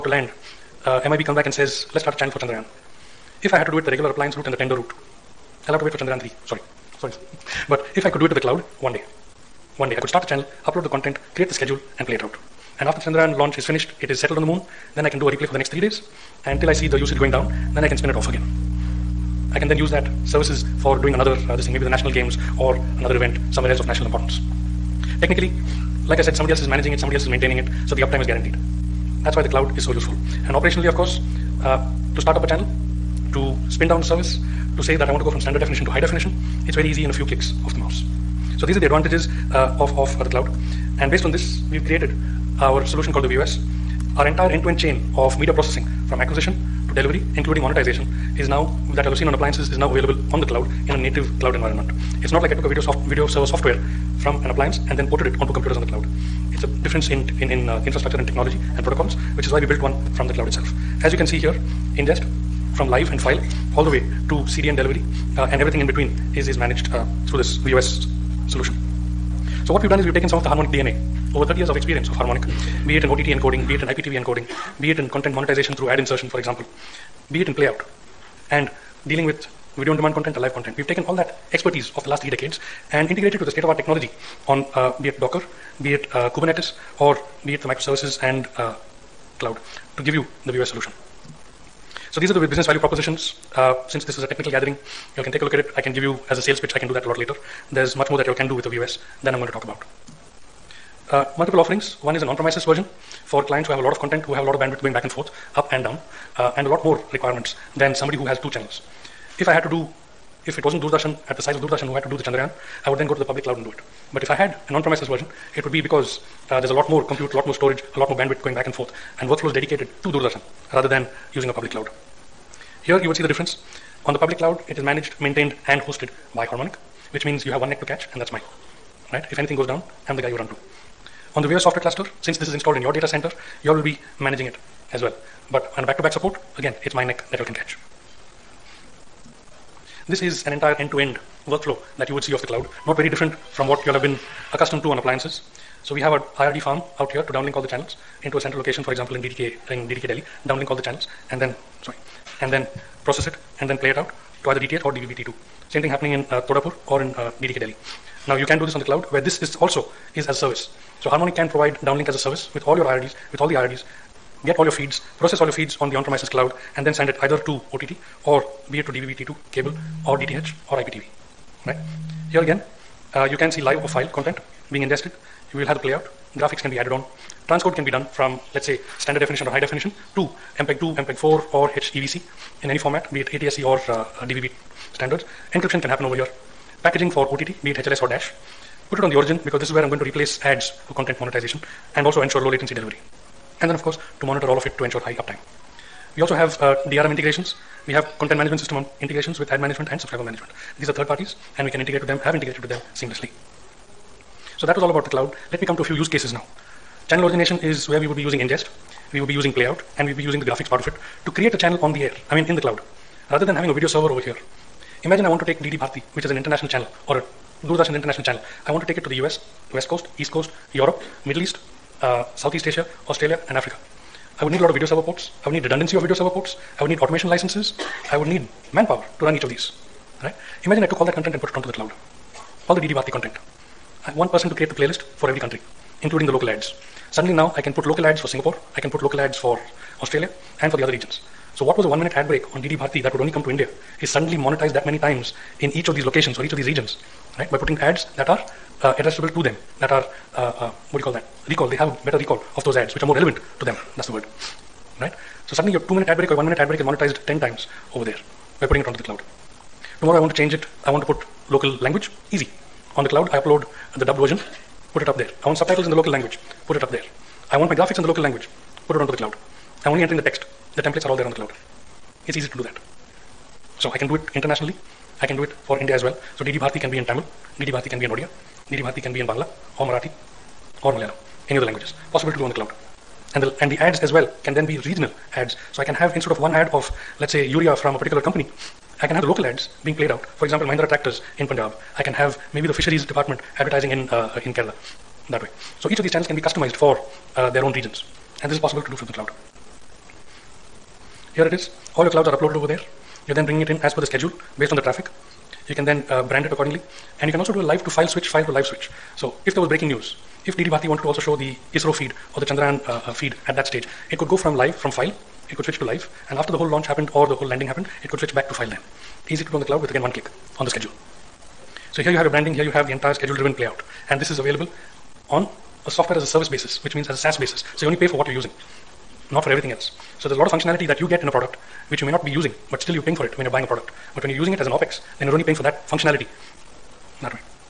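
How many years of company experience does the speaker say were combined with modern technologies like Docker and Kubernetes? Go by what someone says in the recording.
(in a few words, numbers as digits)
30.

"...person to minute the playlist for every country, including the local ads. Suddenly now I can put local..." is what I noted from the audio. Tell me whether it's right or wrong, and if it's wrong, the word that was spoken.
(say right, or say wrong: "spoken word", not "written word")
wrong: "create", not "minute".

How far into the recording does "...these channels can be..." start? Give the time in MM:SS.
04:56.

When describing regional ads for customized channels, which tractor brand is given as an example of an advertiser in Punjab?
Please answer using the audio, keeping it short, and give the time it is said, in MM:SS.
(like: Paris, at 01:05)
Mahindra, at 04:50.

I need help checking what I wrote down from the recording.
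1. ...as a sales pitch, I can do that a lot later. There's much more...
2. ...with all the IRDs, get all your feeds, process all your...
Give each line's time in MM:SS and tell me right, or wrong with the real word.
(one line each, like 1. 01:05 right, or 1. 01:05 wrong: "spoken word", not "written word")
1. 01:36 right
2. 02:43 right.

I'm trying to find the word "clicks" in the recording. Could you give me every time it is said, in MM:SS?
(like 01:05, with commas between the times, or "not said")
00:37, 05:20.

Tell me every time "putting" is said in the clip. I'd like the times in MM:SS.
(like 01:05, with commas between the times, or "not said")
04:07, 04:18.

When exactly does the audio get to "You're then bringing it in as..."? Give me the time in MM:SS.
05:03.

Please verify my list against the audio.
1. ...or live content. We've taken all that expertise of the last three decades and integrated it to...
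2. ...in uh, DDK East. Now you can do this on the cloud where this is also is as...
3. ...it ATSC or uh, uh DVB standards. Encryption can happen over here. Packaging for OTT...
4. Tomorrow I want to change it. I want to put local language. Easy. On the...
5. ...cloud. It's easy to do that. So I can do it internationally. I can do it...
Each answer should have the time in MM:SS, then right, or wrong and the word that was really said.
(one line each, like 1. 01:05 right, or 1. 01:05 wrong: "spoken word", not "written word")
1. 01:20 right
2. 02:37 wrong: "Delhi", not "East"
3. 03:03 right
4. 04:20 right
5. 04:31 right.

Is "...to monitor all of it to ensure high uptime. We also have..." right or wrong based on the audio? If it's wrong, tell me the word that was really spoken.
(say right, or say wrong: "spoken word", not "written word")
right.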